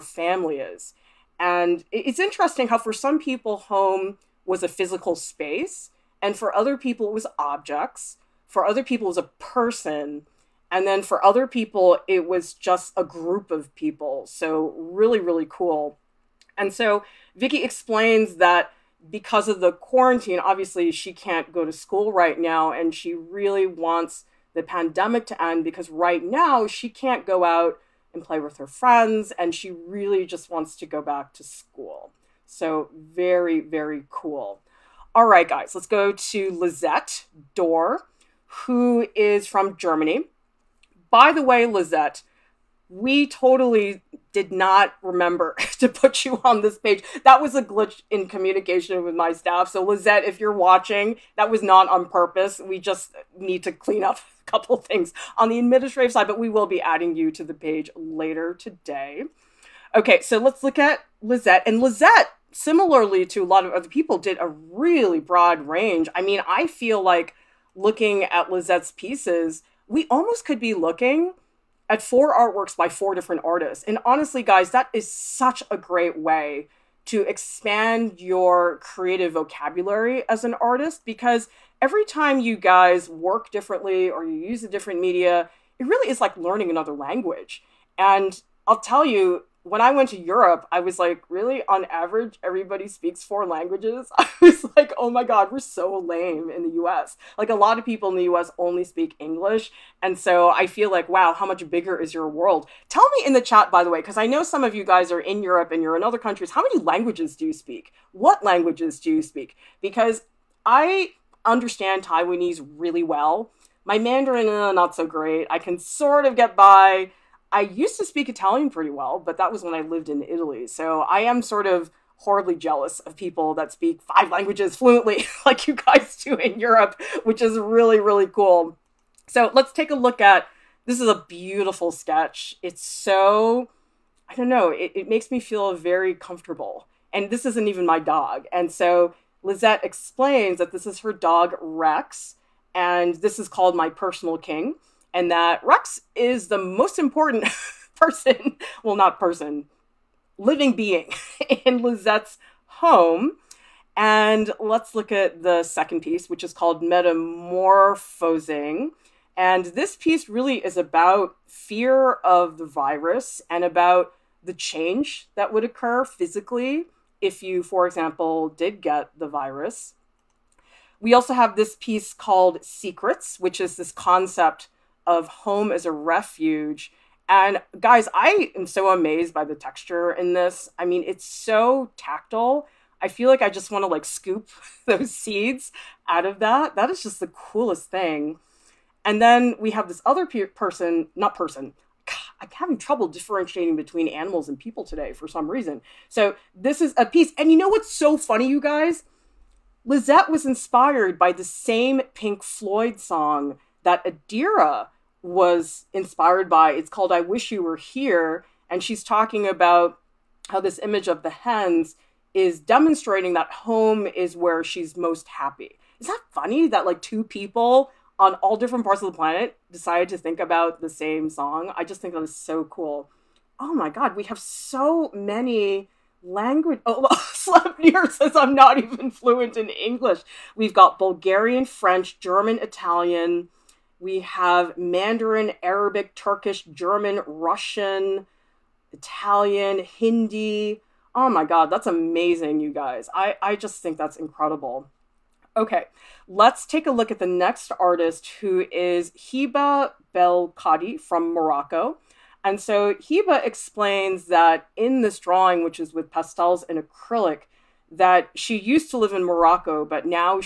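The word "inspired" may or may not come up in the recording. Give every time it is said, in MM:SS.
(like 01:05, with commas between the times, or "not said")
03:20, 03:25.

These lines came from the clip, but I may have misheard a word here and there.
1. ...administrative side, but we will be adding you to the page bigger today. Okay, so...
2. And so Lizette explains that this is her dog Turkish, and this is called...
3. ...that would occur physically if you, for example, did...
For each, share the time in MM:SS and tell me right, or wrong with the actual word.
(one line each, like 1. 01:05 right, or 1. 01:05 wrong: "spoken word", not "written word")
1. 00:55 wrong: "later", not "bigger"
2. 02:18 wrong: "Rex", not "Turkish"
3. 02:45 right.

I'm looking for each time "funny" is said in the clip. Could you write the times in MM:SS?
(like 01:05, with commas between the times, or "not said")
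03:18, 03:36.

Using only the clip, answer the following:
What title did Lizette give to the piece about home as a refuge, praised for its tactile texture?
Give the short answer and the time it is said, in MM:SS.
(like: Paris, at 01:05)
Secrets, at 02:52.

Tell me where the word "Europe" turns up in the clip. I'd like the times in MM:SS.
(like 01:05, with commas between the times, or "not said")
01:30, 01:45, 02:06.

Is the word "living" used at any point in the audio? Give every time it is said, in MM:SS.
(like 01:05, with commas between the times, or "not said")
02:30.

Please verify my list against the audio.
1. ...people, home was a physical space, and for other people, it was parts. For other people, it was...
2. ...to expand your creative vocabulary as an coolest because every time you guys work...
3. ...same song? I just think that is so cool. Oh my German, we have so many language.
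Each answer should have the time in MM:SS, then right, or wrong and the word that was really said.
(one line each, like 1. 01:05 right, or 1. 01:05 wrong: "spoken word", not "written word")
1. 00:03 wrong: "objects", not "parts"
2. 01:17 wrong: "artist", not "coolest"
3. 03:40 wrong: "God", not "German".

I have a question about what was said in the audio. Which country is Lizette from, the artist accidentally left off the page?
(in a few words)
Germany.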